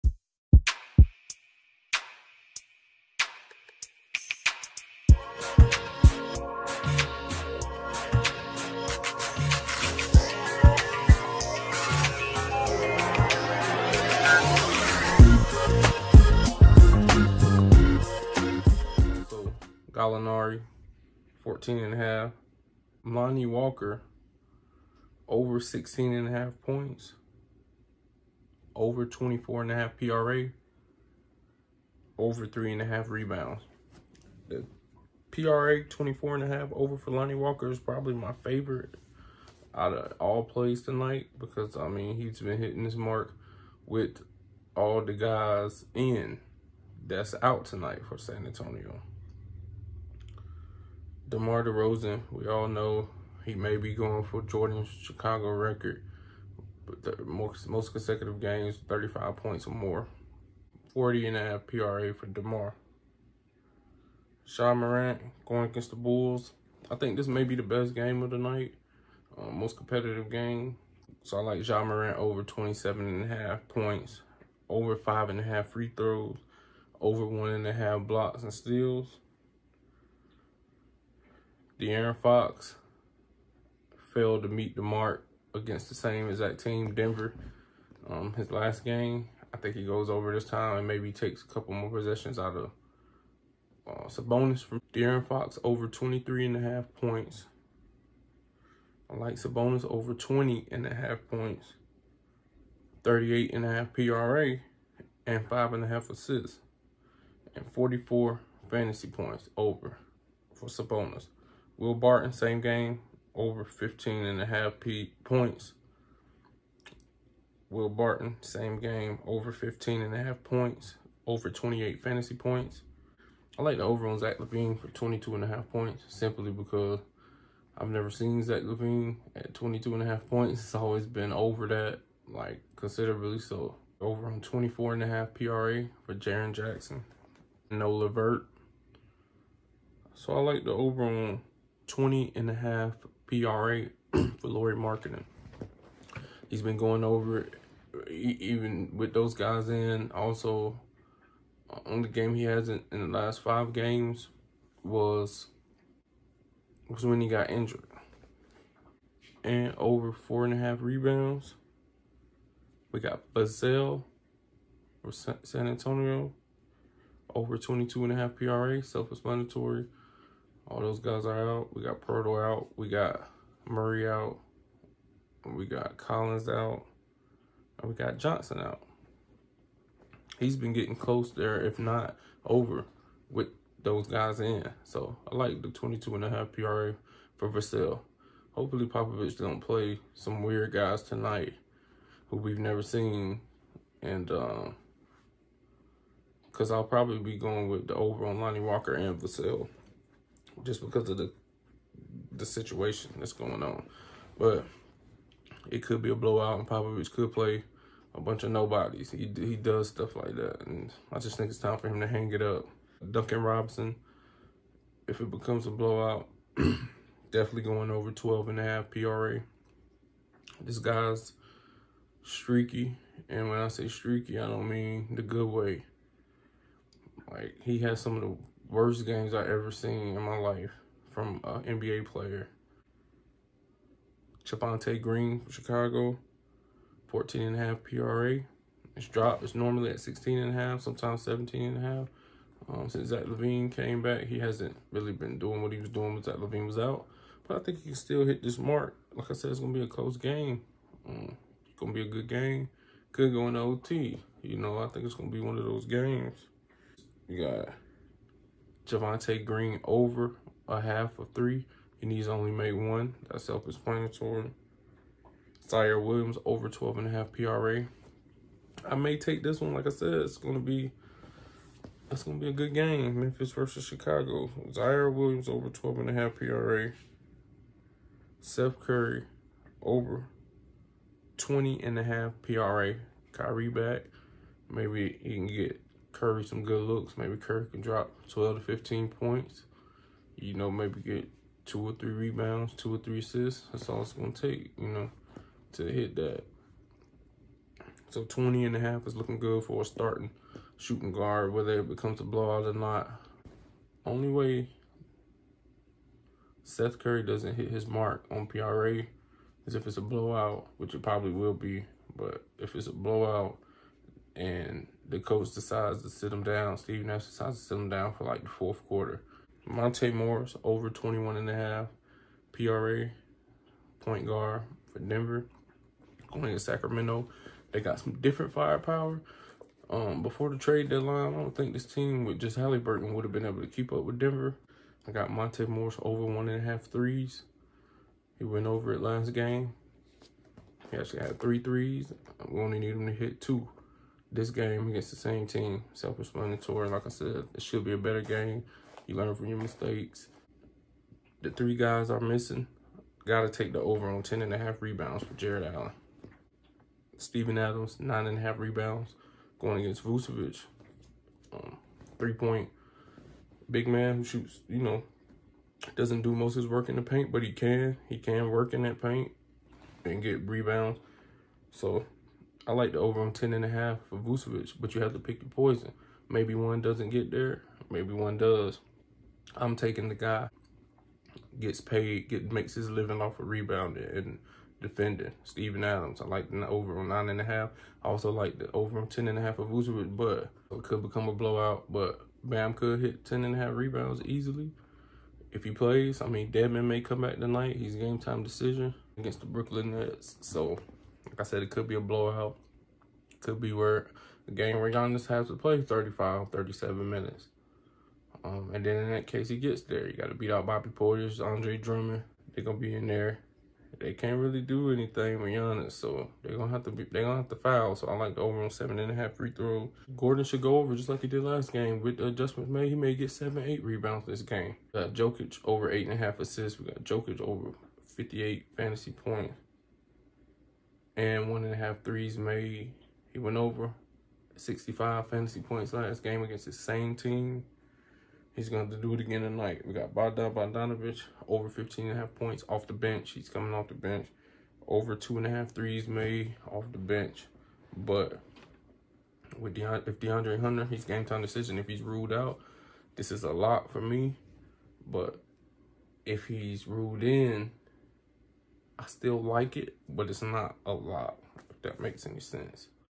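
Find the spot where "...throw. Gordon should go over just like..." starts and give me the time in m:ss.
6:59.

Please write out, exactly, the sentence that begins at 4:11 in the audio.
Um, it's going to be a good game.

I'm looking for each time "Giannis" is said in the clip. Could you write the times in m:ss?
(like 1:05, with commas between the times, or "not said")
6:44, 6:55.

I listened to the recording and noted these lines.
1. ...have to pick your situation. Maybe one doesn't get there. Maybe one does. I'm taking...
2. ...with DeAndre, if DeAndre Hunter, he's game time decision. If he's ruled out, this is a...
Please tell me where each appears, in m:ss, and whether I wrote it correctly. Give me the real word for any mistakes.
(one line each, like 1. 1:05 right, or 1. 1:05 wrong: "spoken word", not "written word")
1. 6:15 wrong: "poison", not "situation"
2. 7:29 right.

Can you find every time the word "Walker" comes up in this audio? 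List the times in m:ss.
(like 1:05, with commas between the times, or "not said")
0:23, 0:37, 3:18.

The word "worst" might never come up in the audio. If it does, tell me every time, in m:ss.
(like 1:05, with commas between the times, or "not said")
3:48.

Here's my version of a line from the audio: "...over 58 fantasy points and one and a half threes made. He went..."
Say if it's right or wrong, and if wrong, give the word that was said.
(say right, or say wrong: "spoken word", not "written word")
right.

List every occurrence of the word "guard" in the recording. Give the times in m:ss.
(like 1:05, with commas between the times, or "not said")
5:01, 5:24.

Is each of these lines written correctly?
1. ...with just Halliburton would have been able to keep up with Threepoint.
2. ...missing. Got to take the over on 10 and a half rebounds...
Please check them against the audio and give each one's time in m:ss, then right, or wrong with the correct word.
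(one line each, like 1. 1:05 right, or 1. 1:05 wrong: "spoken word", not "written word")
1. 5:32 wrong: "Denver", not "Threepoint"
2. 5:52 right.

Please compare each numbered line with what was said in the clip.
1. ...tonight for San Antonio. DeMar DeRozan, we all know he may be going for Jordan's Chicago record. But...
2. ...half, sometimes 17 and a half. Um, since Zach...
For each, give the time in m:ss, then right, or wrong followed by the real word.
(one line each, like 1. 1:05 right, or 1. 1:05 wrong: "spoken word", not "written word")
1. 0:47 right
2. 4:00 right.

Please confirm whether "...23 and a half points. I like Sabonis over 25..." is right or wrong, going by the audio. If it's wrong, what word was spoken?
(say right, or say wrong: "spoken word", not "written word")
wrong: "20", not "25".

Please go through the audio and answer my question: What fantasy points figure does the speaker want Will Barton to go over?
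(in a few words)
28.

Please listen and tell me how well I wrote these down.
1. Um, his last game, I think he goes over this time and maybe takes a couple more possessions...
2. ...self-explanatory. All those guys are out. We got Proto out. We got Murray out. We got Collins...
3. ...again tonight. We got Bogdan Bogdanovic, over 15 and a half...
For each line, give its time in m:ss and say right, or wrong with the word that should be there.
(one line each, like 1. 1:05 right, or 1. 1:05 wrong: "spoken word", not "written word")
1. 1:28 right
2. 2:48 right
3. 7:19 right.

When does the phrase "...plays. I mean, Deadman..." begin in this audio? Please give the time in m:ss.
6:35.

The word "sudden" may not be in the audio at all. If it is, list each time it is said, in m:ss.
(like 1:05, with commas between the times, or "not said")
not said.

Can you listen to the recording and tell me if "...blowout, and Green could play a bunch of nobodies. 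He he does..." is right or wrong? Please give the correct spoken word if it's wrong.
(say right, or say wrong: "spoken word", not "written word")
wrong: "Popovich", not "Green".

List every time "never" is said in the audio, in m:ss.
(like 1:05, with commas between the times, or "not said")
2:07, 3:12.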